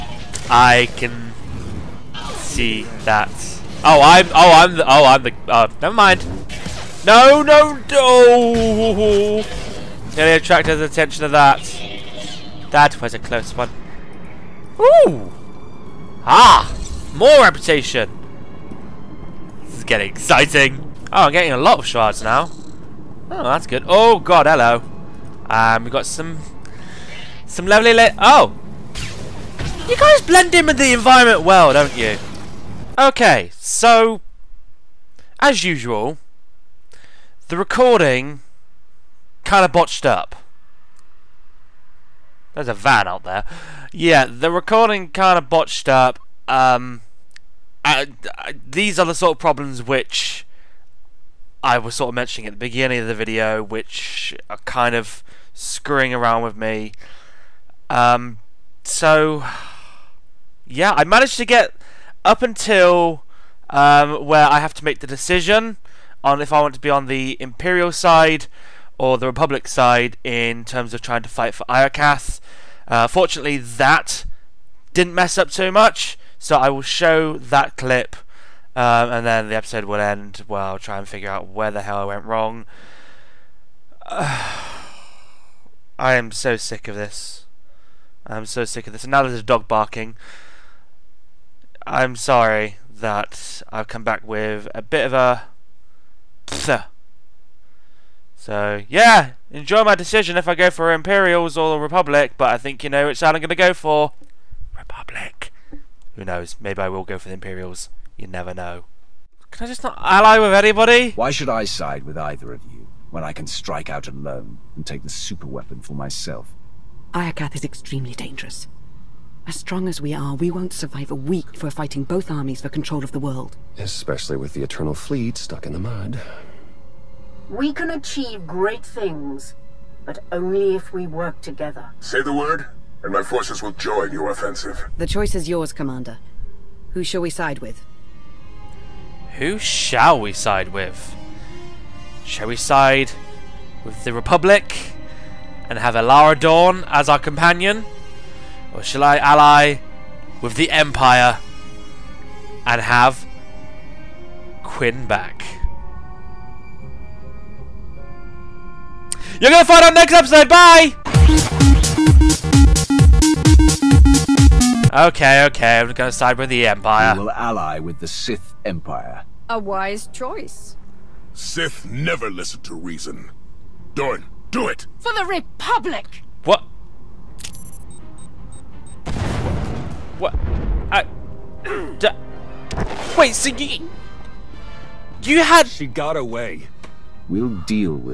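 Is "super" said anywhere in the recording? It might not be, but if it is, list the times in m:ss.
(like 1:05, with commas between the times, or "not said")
1:55.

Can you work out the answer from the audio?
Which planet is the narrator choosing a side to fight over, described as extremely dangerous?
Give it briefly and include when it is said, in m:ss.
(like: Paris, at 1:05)
Iokath, at 1:57.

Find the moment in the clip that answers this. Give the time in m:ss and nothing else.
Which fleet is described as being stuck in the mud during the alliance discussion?
2:04.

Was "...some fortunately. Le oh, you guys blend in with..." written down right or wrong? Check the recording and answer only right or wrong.
wrong.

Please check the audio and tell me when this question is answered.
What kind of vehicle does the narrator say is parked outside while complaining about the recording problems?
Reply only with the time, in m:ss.
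0:42.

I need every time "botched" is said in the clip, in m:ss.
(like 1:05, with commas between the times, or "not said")
0:39, 0:45.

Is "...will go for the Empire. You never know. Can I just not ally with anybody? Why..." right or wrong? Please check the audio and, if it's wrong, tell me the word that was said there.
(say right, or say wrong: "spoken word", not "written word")
wrong: "Imperials", not "Empire".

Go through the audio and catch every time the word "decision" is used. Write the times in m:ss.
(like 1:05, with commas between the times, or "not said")
1:05, 1:39.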